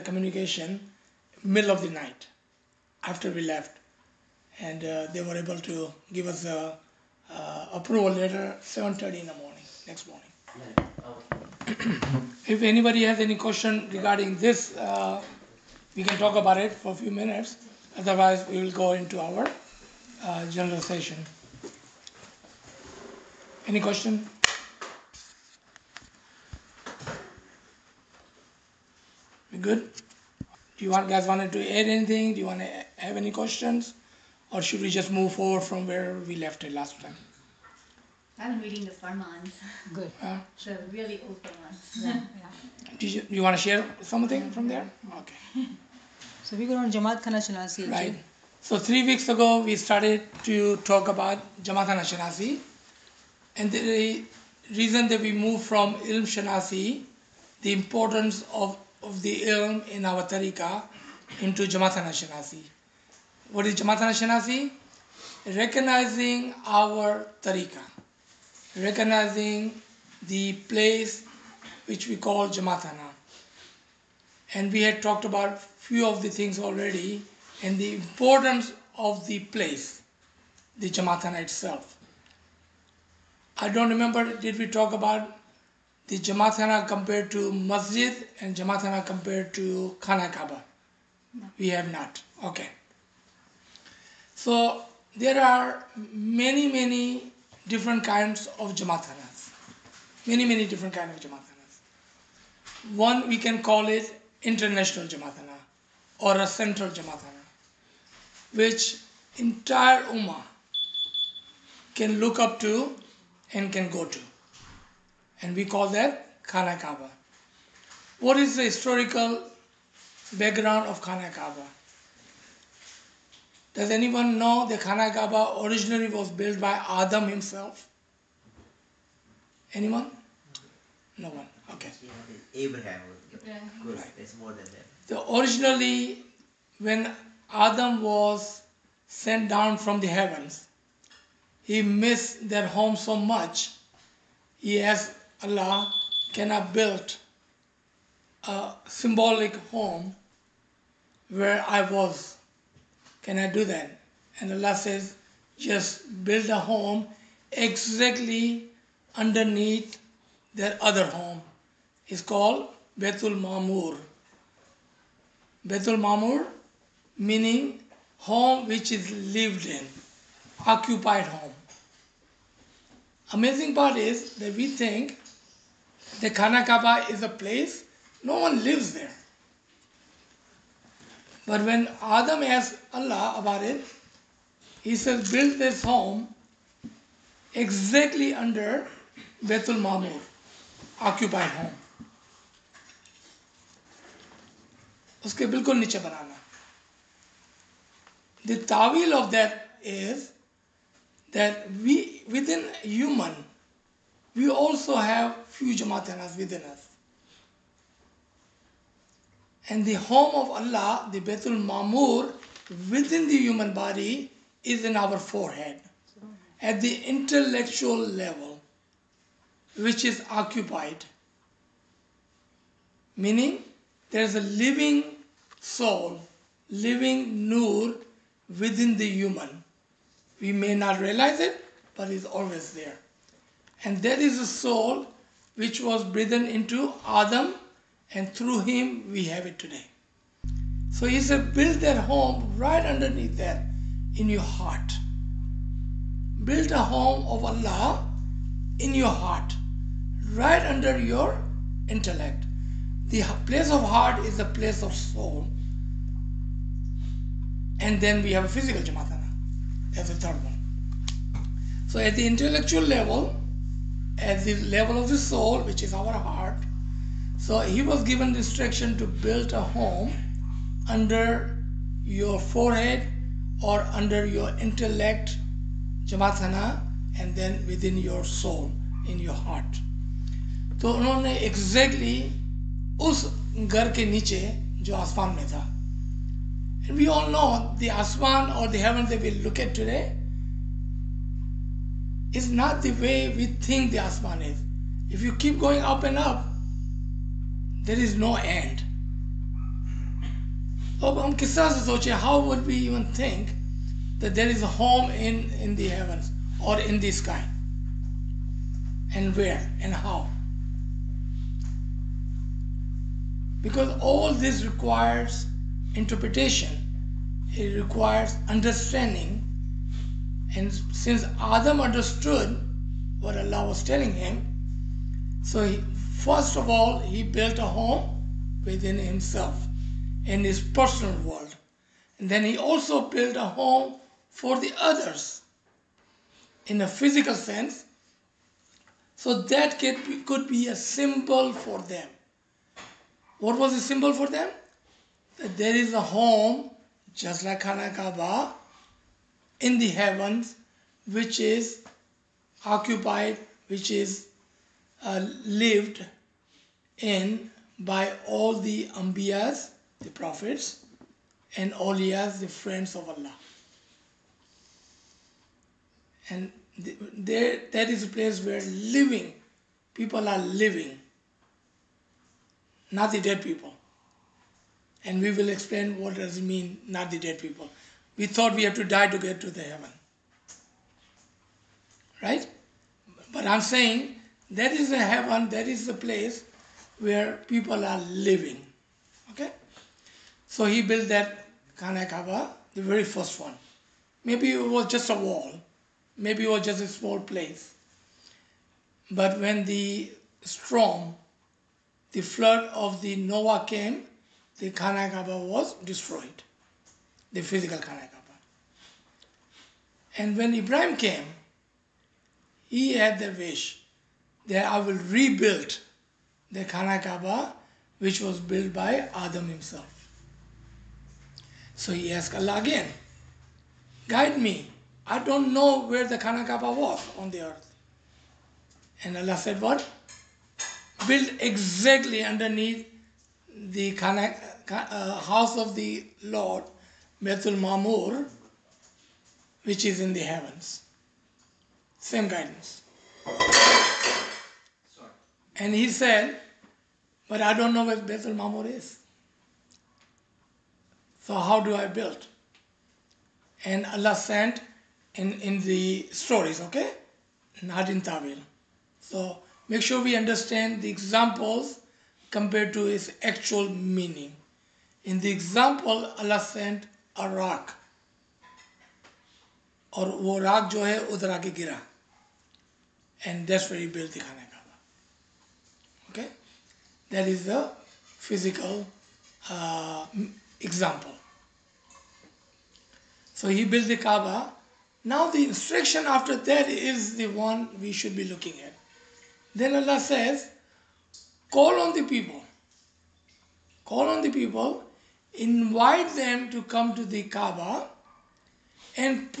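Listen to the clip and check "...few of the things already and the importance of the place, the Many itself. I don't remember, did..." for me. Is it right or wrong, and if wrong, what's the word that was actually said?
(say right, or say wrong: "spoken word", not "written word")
wrong: "Jamathana", not "Many".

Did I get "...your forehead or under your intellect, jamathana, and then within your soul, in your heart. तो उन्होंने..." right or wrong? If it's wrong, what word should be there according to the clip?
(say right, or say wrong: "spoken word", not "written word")
right.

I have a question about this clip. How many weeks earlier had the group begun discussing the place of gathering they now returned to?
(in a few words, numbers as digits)
3.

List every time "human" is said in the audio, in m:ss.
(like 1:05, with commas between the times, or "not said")
3:22, 3:33, 3:49.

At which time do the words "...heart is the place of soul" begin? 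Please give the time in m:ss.
4:13.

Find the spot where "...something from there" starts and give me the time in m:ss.
0:44.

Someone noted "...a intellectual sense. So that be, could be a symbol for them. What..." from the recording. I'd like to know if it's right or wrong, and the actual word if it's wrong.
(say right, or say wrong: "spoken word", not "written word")
wrong: "physical", not "intellectual".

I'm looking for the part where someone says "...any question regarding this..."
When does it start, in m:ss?
0:13.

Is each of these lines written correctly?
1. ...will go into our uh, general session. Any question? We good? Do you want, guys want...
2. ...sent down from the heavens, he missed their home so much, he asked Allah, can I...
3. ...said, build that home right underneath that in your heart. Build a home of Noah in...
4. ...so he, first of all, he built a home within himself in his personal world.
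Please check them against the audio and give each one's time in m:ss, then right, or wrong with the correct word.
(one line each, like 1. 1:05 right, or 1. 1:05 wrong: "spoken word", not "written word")
1. 0:18 right
2. 2:19 right
3. 4:01 wrong: "Allah", not "Noah"
4. 5:25 right.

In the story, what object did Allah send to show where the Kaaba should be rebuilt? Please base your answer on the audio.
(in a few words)
A rock.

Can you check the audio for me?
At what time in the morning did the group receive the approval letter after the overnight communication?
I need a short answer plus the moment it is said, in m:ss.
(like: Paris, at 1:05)
7:30, at 0:08.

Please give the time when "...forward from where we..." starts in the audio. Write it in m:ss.
0:35.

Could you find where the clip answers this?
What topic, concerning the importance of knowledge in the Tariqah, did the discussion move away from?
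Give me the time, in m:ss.
0:56.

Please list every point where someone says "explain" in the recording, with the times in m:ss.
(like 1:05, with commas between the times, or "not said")
6:15.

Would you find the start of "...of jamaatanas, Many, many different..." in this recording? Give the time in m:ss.
1:38.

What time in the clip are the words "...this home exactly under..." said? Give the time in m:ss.
3:05.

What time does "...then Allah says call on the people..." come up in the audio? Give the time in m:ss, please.
8:09.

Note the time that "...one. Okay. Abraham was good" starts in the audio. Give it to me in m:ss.
2:11.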